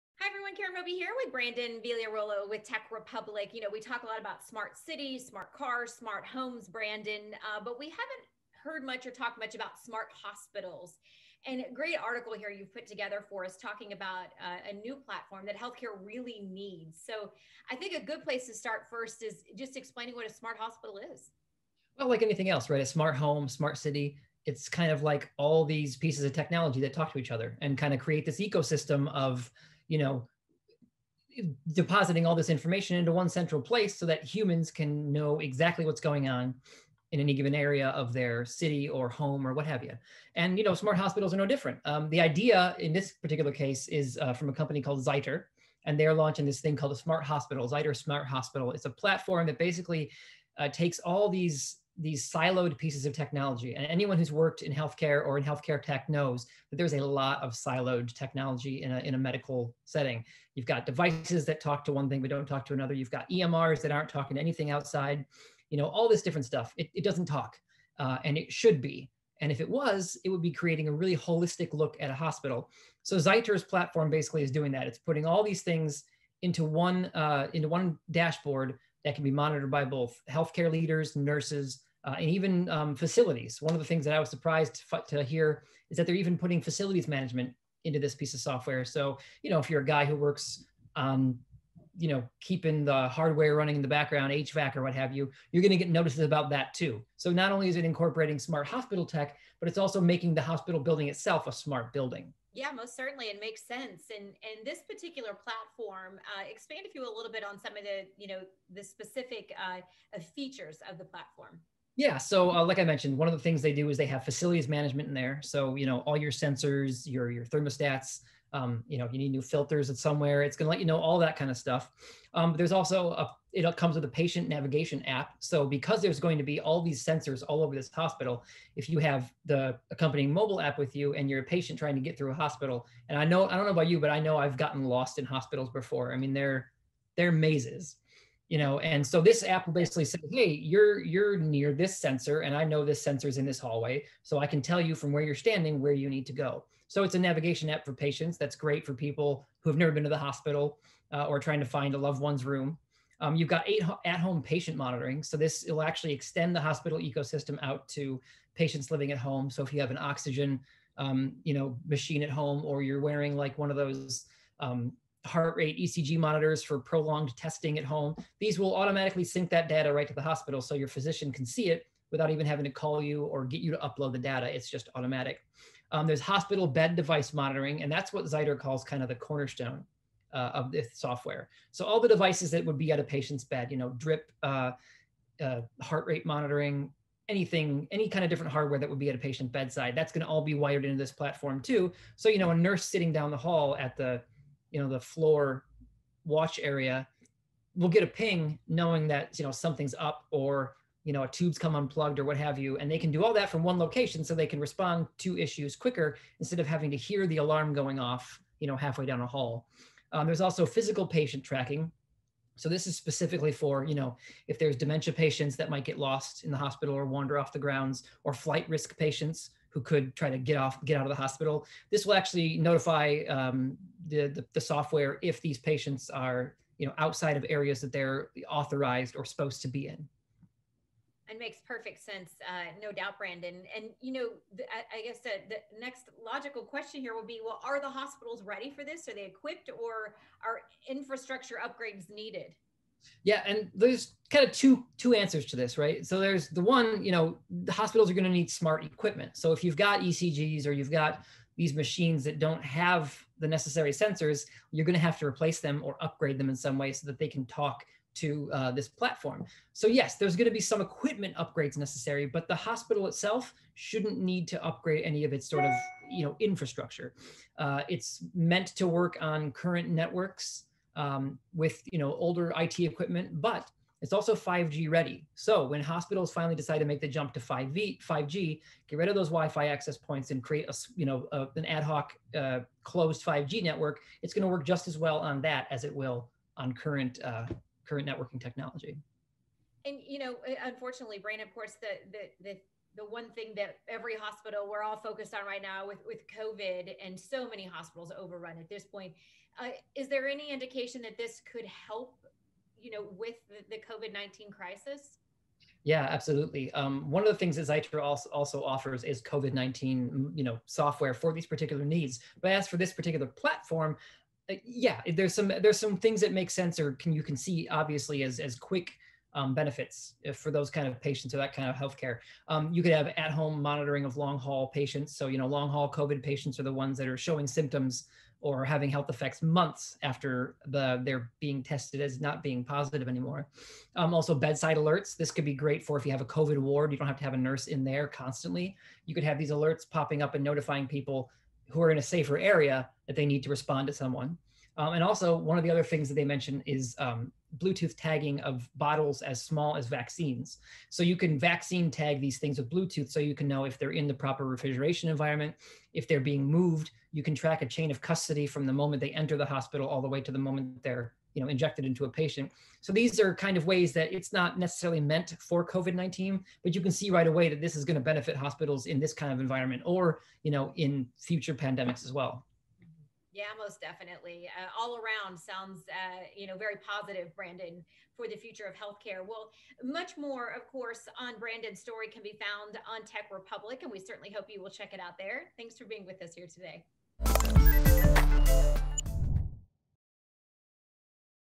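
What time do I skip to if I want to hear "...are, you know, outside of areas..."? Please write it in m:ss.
3:46.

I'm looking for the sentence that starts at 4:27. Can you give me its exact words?
Uh, it's meant to work on current networks um, with you know older IT equipment, but it's also 5G ready.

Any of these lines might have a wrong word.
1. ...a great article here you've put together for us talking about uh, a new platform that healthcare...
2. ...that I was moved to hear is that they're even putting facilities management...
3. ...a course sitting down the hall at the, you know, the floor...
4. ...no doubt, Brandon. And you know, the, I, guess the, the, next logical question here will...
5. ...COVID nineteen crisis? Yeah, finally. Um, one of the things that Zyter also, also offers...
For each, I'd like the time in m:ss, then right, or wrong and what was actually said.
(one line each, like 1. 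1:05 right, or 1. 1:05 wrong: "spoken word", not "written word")
1. 0:11 right
2. 1:24 wrong: "surprised", not "moved"
3. 3:12 wrong: "nurse", not "course"
4. 3:52 right
5. 5:03 wrong: "absolutely", not "finally".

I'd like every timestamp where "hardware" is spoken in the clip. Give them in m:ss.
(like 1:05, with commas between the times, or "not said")
1:33, 3:08.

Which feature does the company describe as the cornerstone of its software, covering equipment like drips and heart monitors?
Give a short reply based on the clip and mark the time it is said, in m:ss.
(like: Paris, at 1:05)
hospital bed device monitoring, at 2:56.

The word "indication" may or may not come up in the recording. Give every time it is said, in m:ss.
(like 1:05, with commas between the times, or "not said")
5:00.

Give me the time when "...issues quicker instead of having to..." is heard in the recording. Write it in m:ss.
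3:25.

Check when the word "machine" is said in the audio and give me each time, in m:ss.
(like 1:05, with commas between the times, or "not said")
2:41, 4:11.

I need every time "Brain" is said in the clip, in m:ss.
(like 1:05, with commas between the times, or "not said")
4:51.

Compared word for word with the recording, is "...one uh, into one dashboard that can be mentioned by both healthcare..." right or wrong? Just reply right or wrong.
wrong.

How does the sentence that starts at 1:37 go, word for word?
So, not only is it incorporating smart hospital tech, but it's also making the hospital building itself a smart building.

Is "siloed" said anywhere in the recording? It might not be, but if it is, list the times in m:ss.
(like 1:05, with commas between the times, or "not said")
0:52, 0:57.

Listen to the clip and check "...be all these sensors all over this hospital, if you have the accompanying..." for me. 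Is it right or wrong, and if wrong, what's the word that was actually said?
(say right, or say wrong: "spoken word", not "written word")
right.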